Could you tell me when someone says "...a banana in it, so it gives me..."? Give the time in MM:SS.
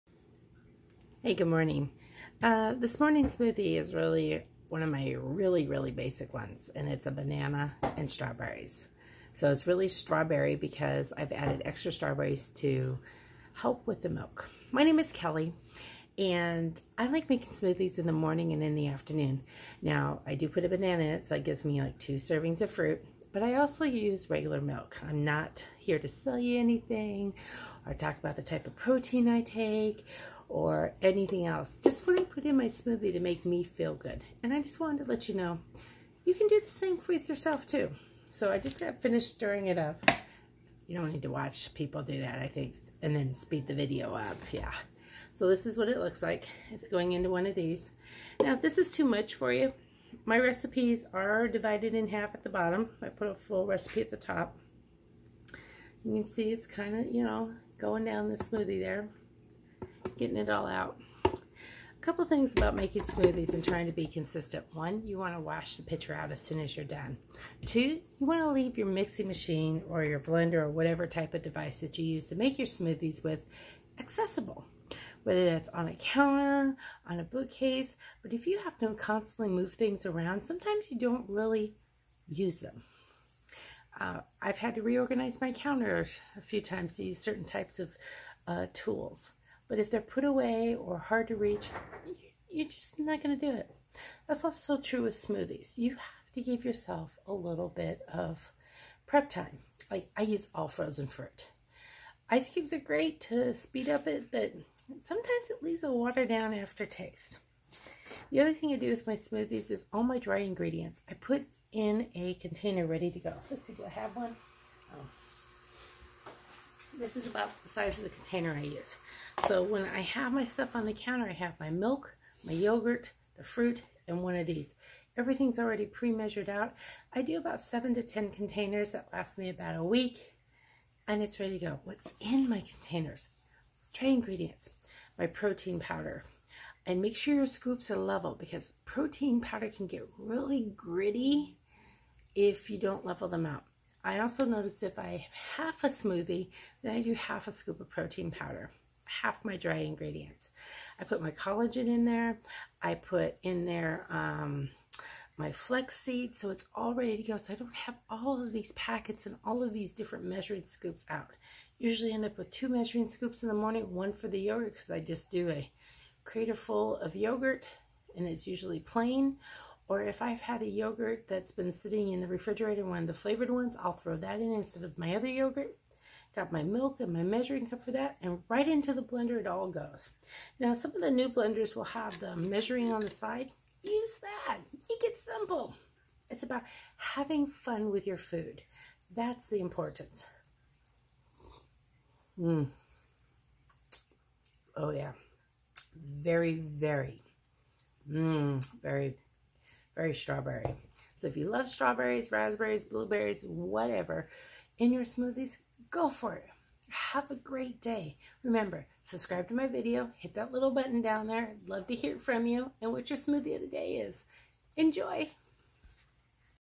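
00:20.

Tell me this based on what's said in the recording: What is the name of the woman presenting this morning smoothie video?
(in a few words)
Kelly.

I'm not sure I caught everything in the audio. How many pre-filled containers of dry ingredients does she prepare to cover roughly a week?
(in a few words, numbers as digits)
7 to 10.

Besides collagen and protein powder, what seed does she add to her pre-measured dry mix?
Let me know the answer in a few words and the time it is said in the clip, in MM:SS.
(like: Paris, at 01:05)
flaxseed, at 02:35.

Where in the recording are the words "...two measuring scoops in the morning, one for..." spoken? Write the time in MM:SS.
02:42.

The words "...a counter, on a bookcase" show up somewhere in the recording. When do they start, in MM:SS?
01:15.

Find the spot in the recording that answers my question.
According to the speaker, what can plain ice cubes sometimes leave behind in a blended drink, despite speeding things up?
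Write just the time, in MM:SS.
01:45.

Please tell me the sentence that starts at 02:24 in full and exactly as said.
I also notice if I have half a smoothie, then I do half a scoop of protein powder, half my dry ingredients.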